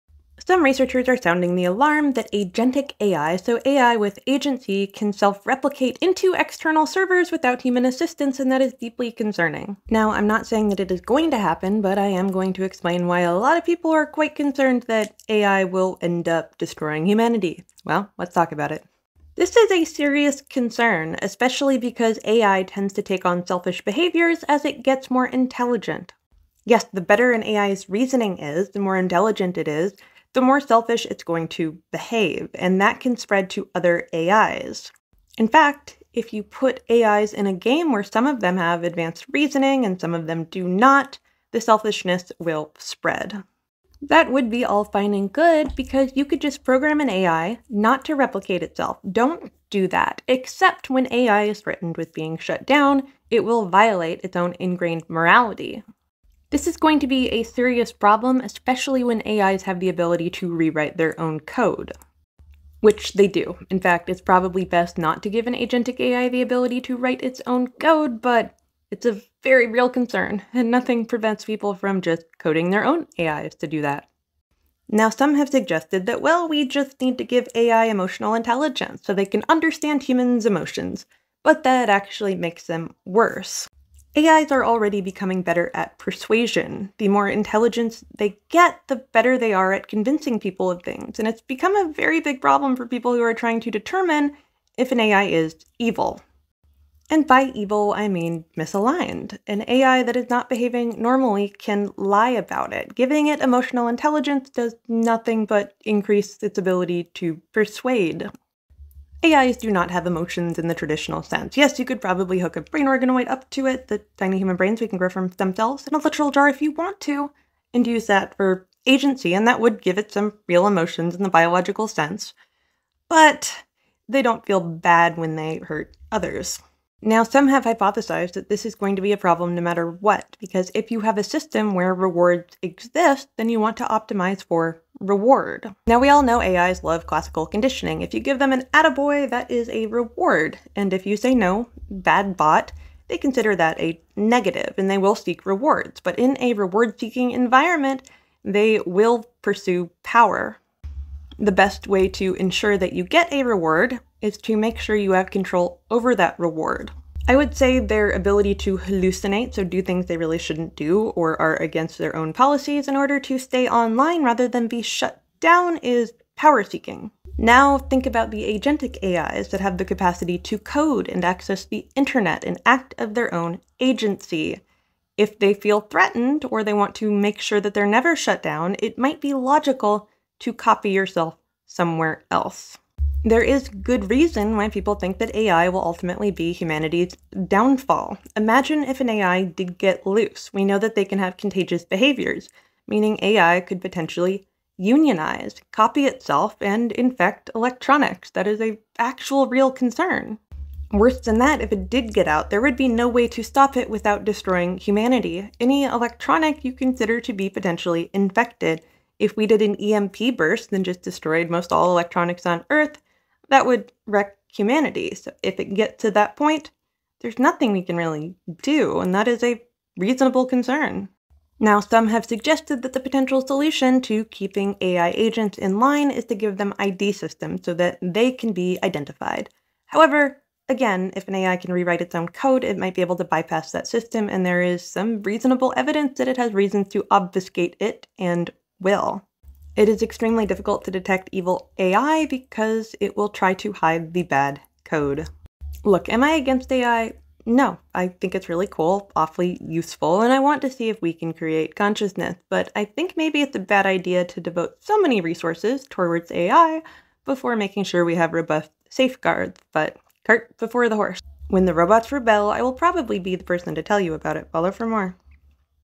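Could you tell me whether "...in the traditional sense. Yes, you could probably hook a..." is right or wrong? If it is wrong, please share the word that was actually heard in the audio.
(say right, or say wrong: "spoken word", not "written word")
right.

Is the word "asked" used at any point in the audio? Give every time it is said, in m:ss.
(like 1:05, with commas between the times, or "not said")
not said.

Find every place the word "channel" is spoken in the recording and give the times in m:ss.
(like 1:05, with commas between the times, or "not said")
not said.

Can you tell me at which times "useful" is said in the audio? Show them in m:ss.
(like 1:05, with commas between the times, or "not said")
4:09.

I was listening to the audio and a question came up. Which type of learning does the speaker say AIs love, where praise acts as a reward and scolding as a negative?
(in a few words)
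classical conditioning.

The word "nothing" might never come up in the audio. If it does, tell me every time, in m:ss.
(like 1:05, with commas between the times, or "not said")
1:10, 1:44, 3:37.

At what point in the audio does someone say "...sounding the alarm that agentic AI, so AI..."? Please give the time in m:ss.
0:01.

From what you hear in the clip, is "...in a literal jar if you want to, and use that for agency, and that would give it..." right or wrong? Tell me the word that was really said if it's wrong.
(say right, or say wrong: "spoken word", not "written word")
right.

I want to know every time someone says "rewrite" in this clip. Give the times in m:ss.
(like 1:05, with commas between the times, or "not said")
1:00, 3:51.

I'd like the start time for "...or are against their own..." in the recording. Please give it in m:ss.
2:41.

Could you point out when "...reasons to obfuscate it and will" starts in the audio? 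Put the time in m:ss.
3:56.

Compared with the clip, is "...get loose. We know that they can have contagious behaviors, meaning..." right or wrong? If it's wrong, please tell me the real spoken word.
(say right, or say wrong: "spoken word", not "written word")
right.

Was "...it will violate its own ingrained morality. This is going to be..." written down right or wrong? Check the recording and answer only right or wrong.
right.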